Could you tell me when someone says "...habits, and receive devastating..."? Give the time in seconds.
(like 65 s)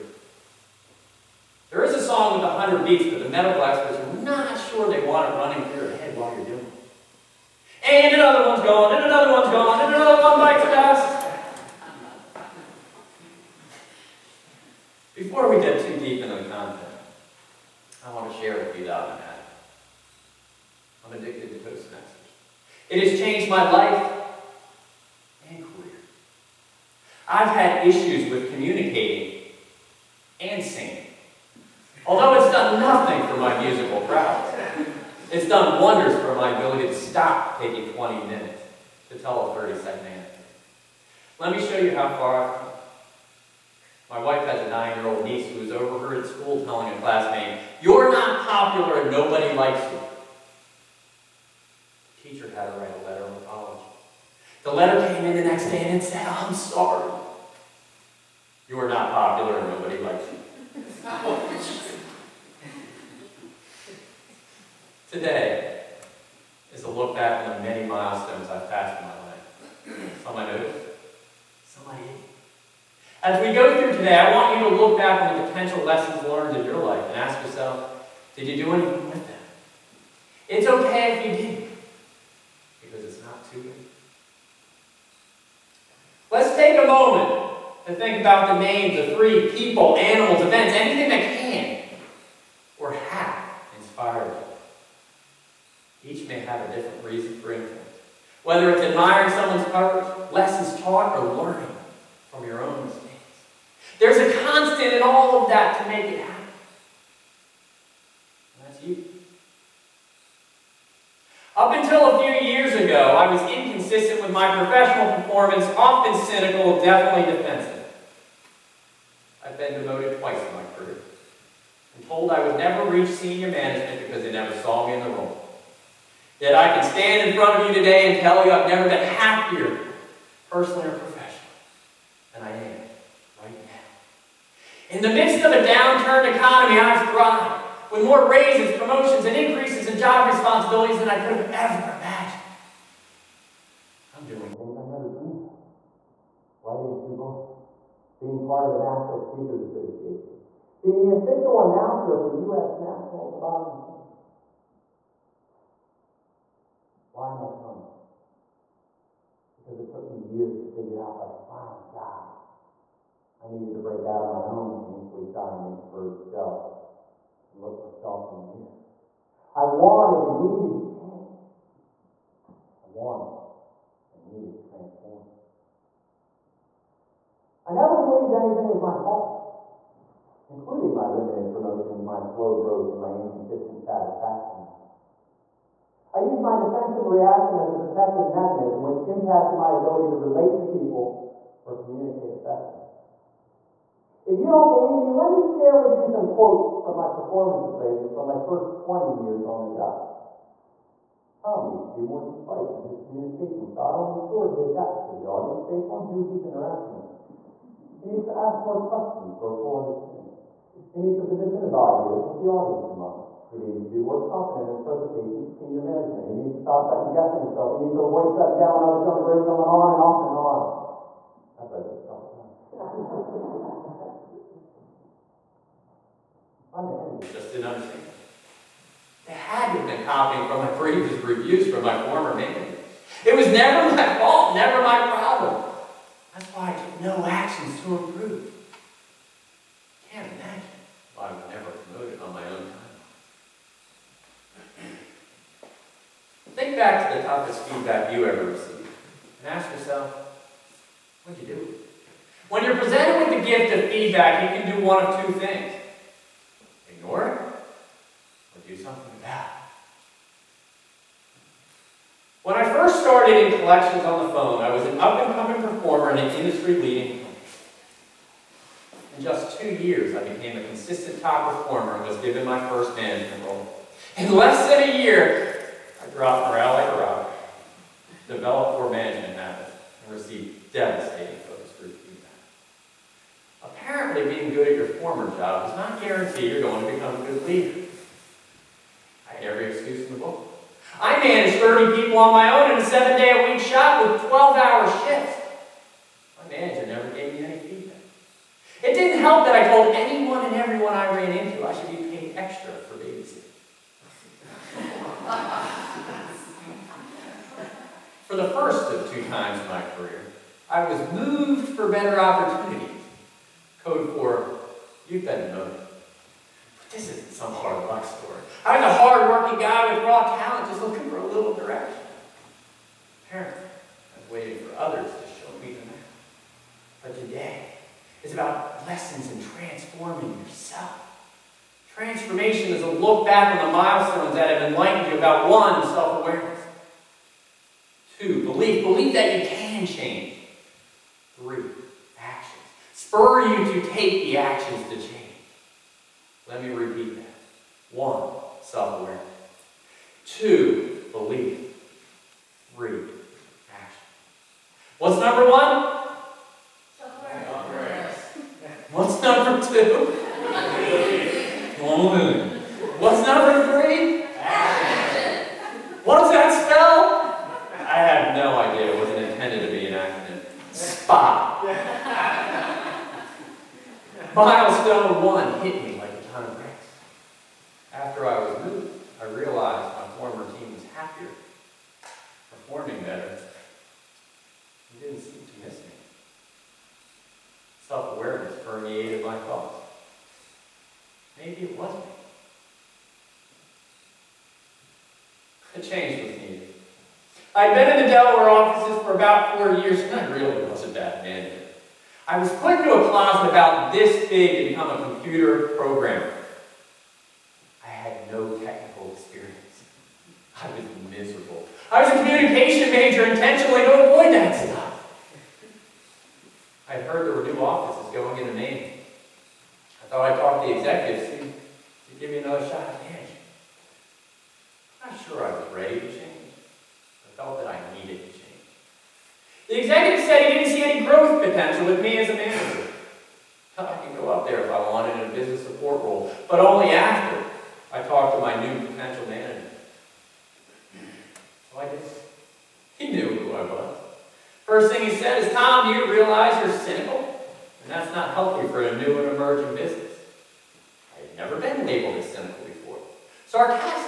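279 s.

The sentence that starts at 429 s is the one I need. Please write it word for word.
The executive said he didn't see any growth potential with me as a manager.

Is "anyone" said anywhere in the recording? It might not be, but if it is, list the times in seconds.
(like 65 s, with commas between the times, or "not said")
299 s.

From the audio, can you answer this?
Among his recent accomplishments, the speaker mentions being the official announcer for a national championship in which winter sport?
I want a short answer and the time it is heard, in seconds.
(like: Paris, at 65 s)
Toboggan, at 153 s.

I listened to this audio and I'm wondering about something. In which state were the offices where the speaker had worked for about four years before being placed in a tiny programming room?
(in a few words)
Delaware.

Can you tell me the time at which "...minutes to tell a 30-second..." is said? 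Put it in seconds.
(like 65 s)
38 s.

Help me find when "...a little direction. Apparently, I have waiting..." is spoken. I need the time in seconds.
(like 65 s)
321 s.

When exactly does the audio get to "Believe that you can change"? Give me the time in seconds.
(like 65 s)
338 s.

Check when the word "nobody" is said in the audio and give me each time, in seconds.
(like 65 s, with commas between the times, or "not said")
49 s, 59 s.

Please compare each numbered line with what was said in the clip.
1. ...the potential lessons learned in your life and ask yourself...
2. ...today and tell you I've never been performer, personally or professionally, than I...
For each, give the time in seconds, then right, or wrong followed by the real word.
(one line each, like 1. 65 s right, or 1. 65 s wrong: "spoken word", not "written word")
1. 75 s right
2. 127 s wrong: "happier", not "performer".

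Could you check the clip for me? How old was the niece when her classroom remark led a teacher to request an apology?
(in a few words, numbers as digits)
9.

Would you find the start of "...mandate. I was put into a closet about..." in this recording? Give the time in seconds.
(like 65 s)
401 s.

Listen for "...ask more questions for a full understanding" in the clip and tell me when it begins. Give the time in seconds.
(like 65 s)
208 s.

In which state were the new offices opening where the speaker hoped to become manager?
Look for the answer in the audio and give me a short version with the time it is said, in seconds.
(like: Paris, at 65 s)
Maine, at 418 s.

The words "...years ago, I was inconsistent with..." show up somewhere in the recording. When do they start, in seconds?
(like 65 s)
112 s.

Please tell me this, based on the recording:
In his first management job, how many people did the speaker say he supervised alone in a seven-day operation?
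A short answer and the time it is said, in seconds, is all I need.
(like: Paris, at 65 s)
30, at 291 s.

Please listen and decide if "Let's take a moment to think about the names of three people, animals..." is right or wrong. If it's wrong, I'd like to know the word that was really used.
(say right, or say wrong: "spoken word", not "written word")
right.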